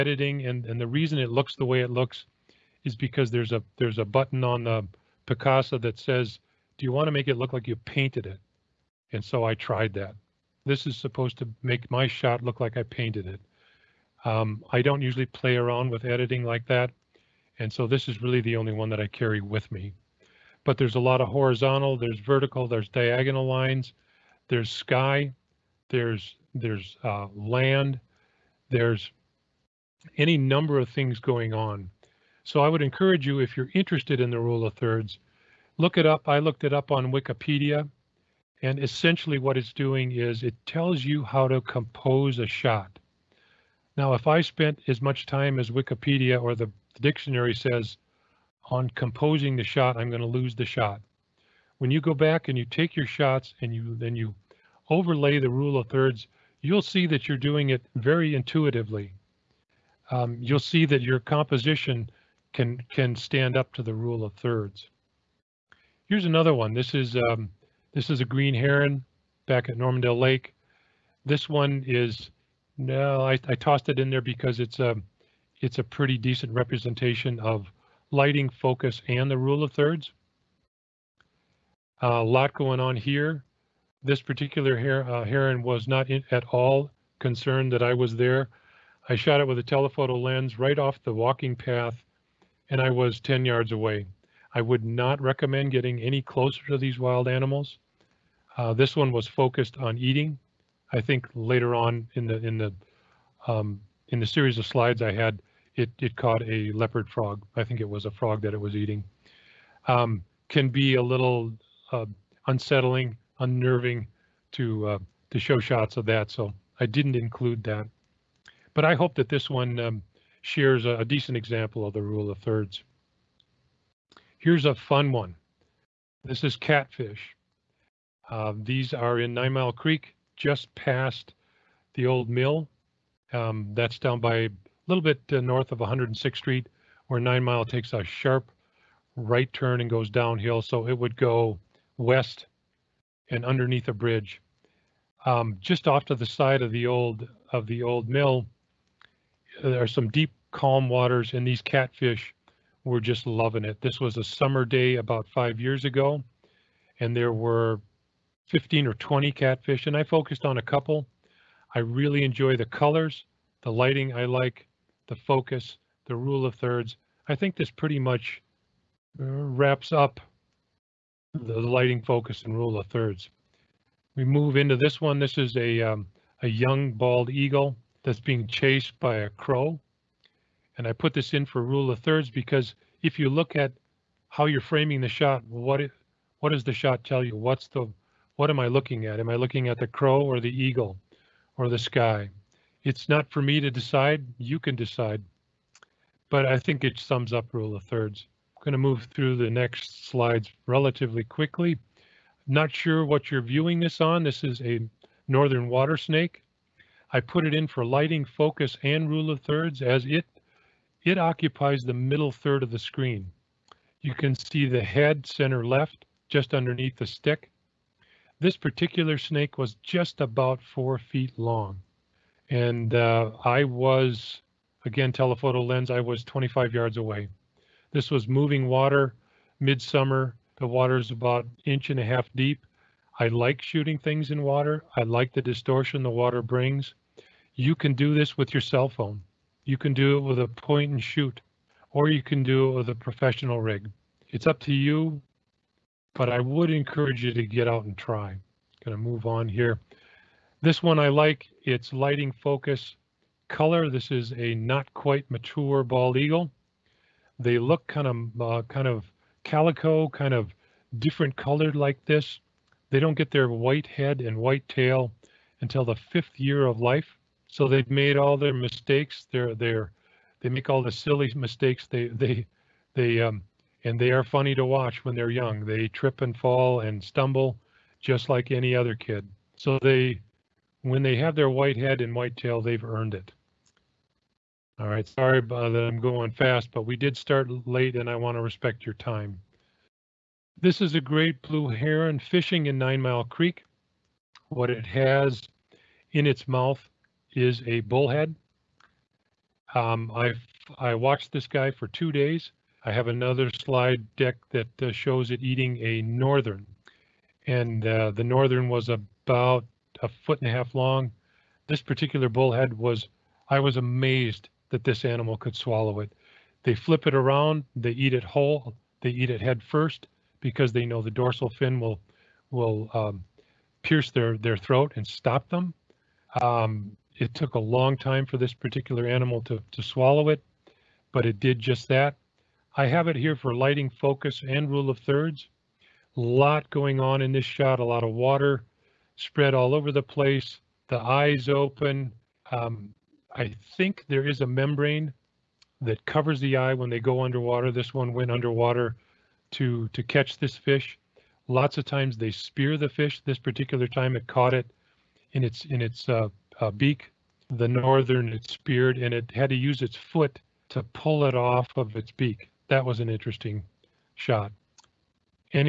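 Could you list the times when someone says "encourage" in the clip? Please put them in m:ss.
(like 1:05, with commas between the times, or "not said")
0:32, 4:06.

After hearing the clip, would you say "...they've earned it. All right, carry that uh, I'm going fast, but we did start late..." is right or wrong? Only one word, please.
wrong.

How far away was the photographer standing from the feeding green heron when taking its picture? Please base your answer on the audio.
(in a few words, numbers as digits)
10 yards.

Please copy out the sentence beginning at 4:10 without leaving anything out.
This one I like, it's lighting focus color.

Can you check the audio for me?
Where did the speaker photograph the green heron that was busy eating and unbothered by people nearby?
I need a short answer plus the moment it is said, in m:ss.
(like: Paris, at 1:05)
Normandale Lake, at 1:09.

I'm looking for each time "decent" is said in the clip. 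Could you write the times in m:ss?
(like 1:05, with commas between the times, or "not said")
1:16, 2:01.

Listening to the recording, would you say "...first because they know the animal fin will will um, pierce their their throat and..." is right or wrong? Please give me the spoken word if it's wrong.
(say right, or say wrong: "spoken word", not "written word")
wrong: "dorsal", not "animal".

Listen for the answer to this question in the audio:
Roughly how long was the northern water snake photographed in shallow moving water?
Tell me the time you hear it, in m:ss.
3:40.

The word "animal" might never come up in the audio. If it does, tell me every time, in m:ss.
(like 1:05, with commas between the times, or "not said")
1:37, 5:15, 5:29.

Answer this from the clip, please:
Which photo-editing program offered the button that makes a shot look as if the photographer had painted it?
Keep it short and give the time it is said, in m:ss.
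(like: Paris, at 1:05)
Picasa, at 0:05.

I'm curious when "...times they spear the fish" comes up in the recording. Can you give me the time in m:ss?
5:51.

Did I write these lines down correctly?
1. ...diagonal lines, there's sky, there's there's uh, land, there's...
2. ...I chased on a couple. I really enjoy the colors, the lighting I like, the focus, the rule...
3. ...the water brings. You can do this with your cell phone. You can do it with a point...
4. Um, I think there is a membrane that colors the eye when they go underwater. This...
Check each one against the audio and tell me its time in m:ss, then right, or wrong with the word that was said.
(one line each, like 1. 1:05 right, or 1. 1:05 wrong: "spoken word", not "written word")
1. 0:22 right
2. 2:39 wrong: "focused", not "chased"
3. 3:56 right
4. 5:42 wrong: "covers", not "colors".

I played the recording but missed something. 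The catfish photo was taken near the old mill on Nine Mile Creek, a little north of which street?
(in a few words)
106th Street.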